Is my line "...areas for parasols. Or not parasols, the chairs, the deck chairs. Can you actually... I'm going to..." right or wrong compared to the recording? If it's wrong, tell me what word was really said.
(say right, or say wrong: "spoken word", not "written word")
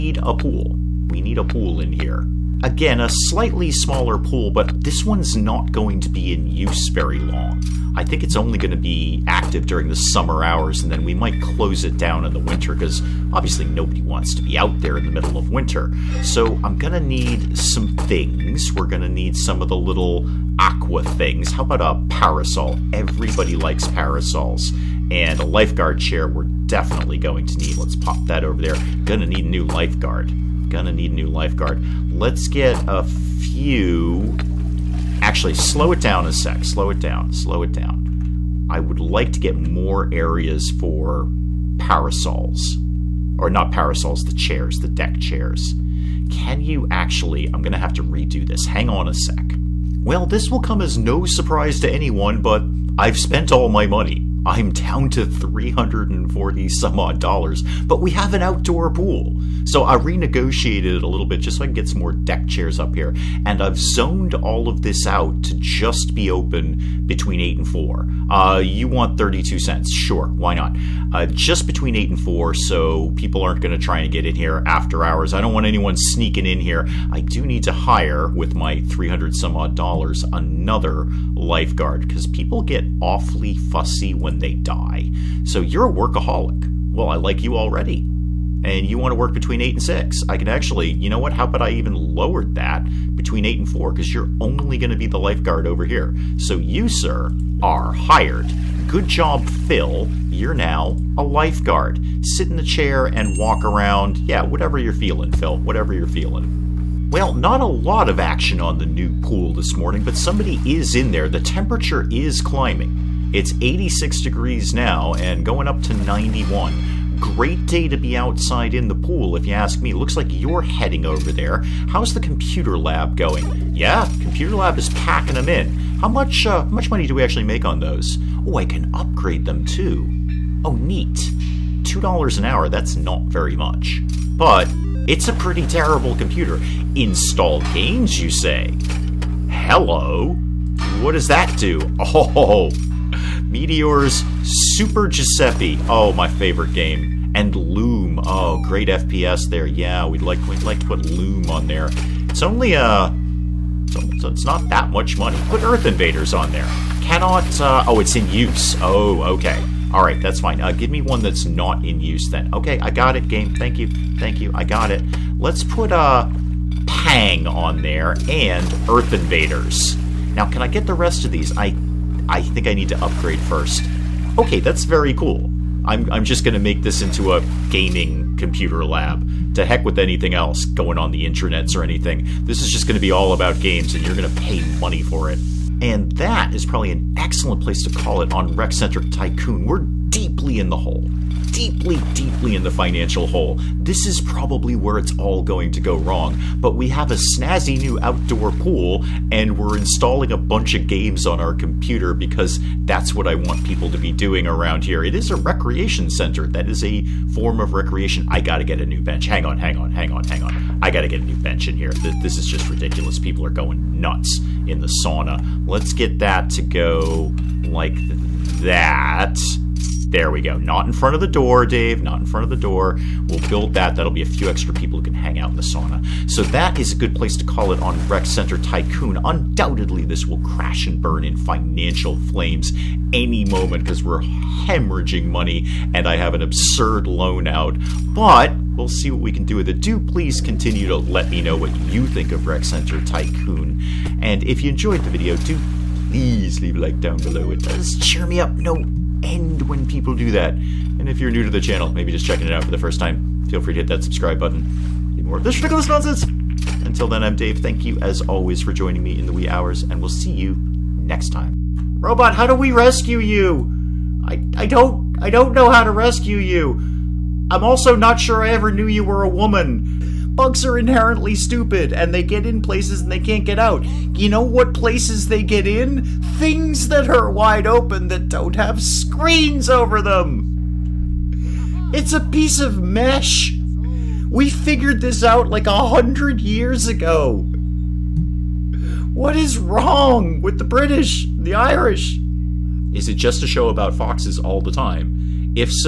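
right.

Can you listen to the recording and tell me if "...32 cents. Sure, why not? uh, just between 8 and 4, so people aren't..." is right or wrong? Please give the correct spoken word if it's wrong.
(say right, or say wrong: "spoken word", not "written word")
right.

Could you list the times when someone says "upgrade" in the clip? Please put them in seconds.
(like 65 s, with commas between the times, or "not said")
128 s, 173 s.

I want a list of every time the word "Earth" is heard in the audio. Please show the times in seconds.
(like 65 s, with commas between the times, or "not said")
155 s, 168 s.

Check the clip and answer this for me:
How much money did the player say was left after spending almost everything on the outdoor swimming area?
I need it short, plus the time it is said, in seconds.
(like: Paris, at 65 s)
$340, at 55 s.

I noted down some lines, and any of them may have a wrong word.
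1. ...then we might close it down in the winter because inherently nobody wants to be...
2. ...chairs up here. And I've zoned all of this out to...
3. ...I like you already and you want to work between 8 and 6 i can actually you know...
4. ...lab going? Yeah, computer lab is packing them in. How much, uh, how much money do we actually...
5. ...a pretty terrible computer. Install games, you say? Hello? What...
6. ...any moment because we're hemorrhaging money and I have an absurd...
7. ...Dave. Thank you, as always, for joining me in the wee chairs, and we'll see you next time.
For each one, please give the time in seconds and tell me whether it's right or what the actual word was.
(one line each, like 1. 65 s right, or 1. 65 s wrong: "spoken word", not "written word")
1. 10 s wrong: "obviously", not "inherently"
2. 62 s right
3. 87 s right
4. 122 s right
5. 135 s right
6. 233 s right
7. 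257 s wrong: "hours", not "chairs".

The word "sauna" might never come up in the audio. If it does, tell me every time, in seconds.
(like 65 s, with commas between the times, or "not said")
215 s, 225 s.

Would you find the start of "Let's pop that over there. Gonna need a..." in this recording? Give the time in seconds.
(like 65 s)
27 s.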